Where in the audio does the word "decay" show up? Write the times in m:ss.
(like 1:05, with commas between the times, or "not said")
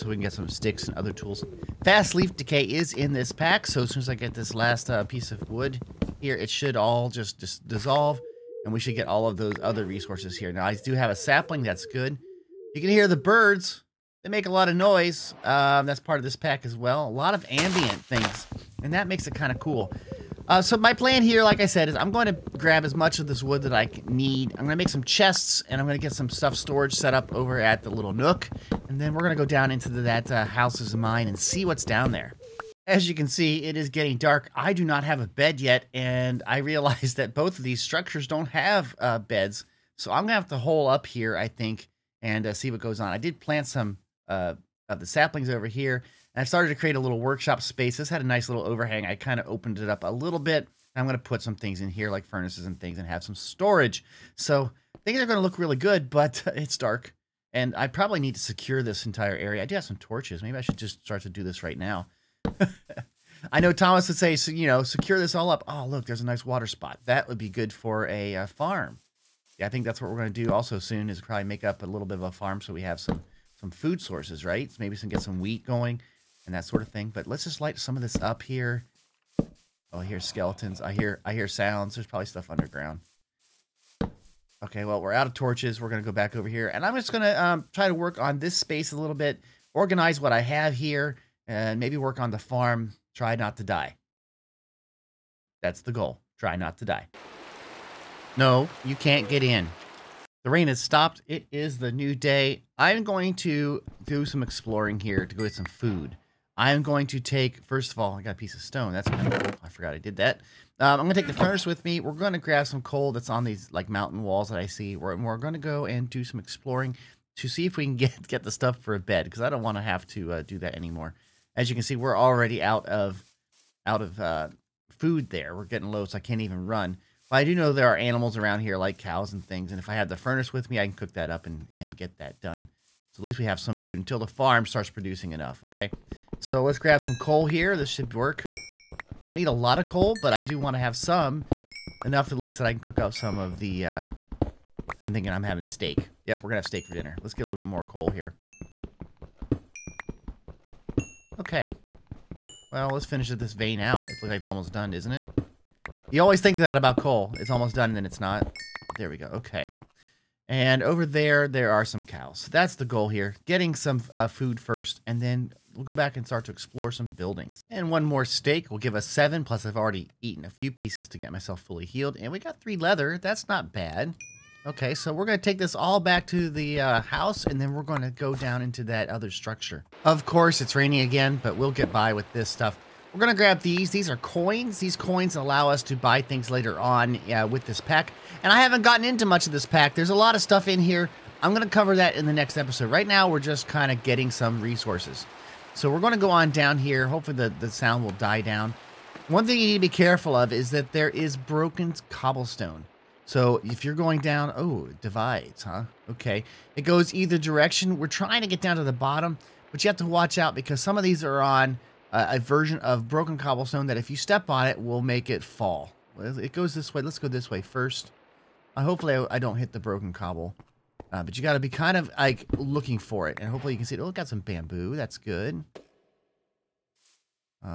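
0:02.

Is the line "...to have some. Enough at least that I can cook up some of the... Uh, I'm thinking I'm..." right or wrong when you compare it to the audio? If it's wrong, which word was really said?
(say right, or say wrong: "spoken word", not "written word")
right.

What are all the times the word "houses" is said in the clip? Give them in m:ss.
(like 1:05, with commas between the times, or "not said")
0:30, 2:57.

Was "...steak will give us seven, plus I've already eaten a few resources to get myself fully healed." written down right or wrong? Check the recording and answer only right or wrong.
wrong.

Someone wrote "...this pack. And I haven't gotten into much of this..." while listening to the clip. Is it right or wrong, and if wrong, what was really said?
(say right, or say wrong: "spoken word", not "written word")
right.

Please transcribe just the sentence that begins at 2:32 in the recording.
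Well, let's finish this vein out.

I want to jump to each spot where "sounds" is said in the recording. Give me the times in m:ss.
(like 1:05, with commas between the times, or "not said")
1:21, 3:17.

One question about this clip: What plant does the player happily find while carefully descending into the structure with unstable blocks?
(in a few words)
Bamboo.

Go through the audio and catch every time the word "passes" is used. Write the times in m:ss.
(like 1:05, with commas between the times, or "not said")
not said.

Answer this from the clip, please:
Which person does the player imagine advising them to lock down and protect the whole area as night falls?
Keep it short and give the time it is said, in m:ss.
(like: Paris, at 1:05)
Thomas, at 1:03.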